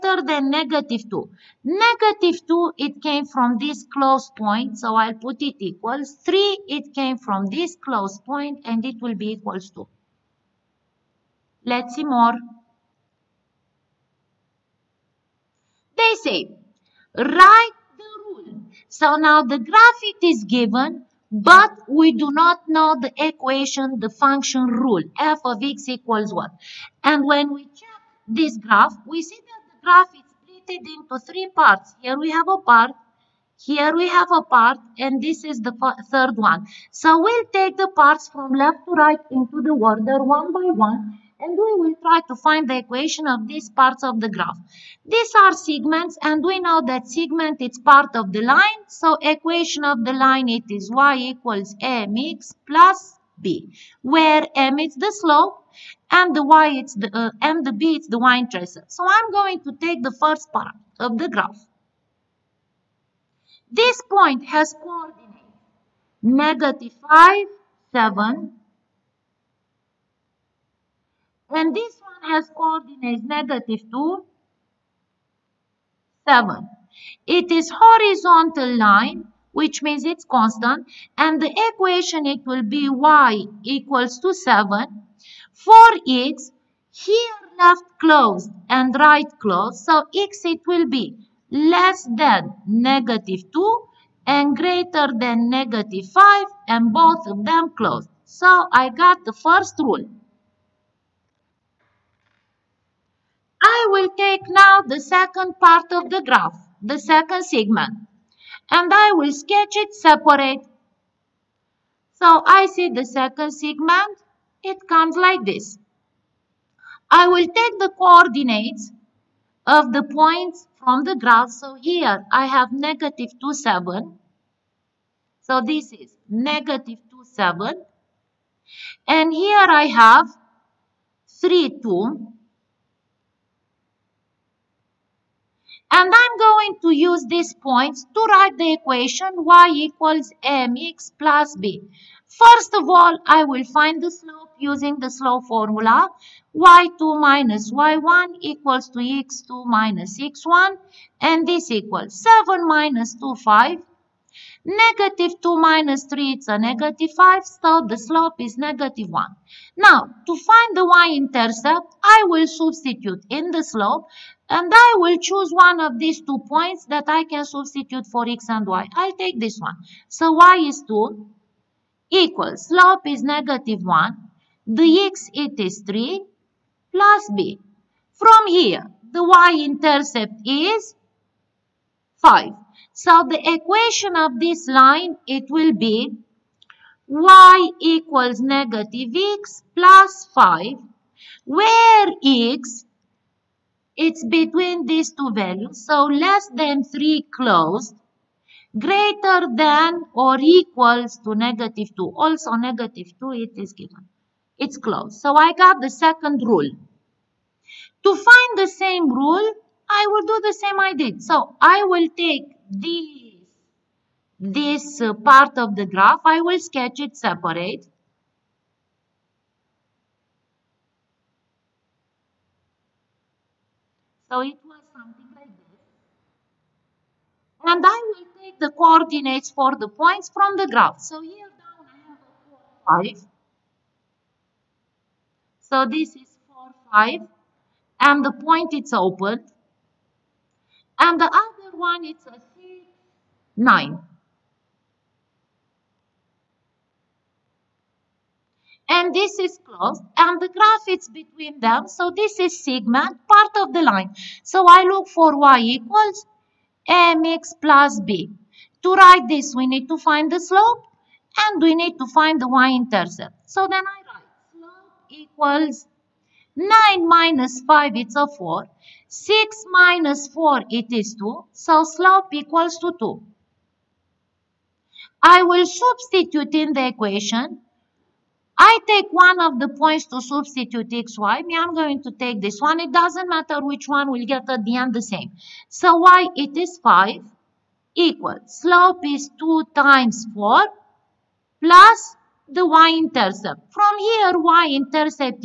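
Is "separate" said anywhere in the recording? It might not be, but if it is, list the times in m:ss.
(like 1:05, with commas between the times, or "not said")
1:49, 3:37.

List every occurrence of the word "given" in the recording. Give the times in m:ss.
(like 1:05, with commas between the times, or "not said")
0:20, 3:23.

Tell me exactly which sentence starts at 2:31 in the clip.
And this equals 7 minus 2, 5.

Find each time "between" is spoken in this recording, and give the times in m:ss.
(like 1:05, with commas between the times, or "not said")
3:14, 4:11.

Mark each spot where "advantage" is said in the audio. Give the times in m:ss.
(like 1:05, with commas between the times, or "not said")
not said.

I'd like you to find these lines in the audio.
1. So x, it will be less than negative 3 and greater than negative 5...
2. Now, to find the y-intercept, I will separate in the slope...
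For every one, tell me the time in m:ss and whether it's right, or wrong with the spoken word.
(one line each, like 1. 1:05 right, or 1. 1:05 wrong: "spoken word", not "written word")
1. 1:29 wrong: "2", not "3"
2. 2:39 wrong: "substitute", not "separate".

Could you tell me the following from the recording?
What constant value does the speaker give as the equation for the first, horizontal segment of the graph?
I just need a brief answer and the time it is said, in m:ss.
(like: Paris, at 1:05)
y = 7, at 1:22.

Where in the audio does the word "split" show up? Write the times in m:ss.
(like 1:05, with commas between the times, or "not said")
0:30.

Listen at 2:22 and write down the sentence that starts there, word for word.
First of all, I will find the slope using the slope formula.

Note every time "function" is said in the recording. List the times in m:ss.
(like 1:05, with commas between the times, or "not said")
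0:24.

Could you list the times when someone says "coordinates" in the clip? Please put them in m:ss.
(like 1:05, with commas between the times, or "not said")
1:04, 1:12, 1:57, 3:48.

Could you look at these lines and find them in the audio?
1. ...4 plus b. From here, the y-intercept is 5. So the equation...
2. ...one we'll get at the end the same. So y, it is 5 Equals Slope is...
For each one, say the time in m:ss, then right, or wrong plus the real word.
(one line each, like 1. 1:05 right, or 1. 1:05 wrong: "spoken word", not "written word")
1. 2:55 wrong: "3", not "4"
2. 4:43 right.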